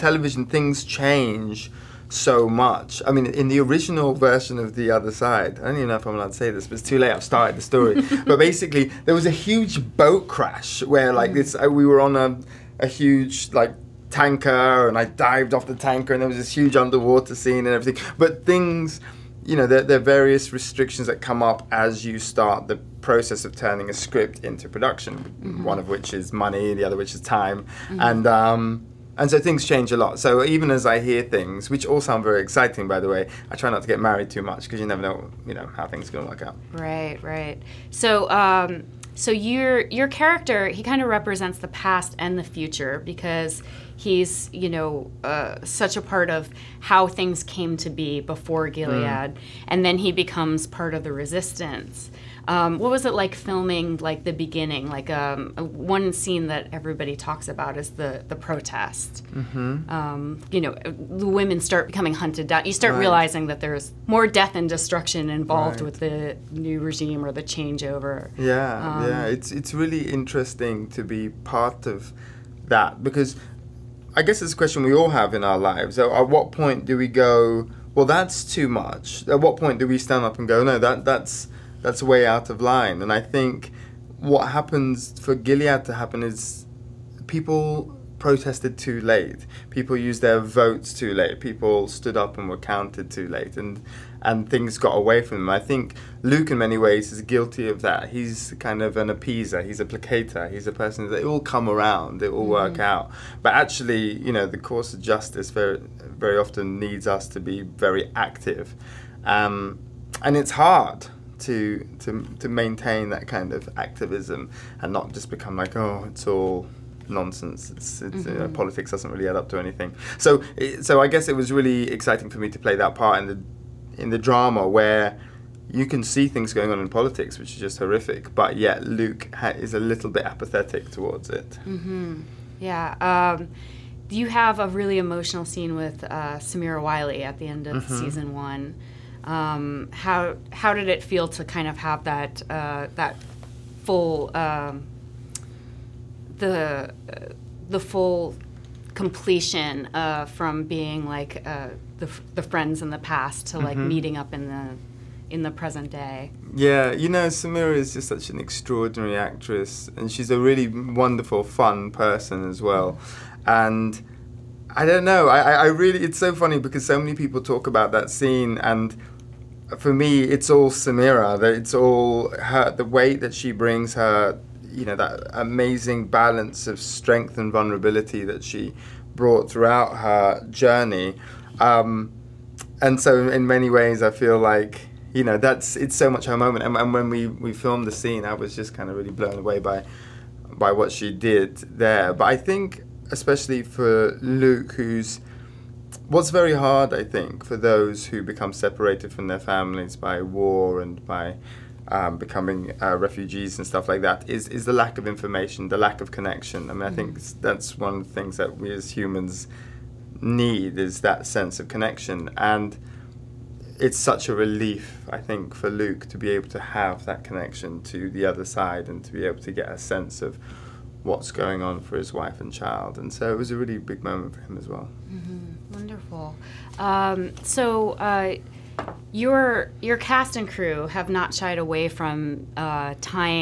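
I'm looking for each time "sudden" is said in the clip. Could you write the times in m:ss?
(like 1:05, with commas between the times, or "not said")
not said.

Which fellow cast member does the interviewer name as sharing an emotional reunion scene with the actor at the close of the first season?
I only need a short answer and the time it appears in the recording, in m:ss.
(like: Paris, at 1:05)
Samira Wiley, at 2:16.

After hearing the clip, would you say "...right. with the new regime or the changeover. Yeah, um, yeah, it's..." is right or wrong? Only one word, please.
right.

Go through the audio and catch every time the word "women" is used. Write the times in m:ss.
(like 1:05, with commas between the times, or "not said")
1:01.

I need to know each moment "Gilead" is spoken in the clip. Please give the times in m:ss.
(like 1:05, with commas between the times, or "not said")
0:48, 1:25.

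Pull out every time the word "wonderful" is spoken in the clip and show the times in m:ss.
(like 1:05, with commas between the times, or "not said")
2:40, 3:45.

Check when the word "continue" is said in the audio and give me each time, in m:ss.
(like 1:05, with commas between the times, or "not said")
not said.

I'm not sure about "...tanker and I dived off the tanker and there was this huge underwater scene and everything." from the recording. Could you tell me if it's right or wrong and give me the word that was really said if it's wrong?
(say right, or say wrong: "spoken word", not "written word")
right.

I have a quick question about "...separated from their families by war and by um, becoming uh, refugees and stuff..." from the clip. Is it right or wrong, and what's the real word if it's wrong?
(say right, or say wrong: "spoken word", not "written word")
right.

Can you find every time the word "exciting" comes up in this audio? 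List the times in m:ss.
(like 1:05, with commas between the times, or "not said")
0:32, 2:01.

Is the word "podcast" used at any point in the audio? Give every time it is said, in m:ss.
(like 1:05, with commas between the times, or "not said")
not said.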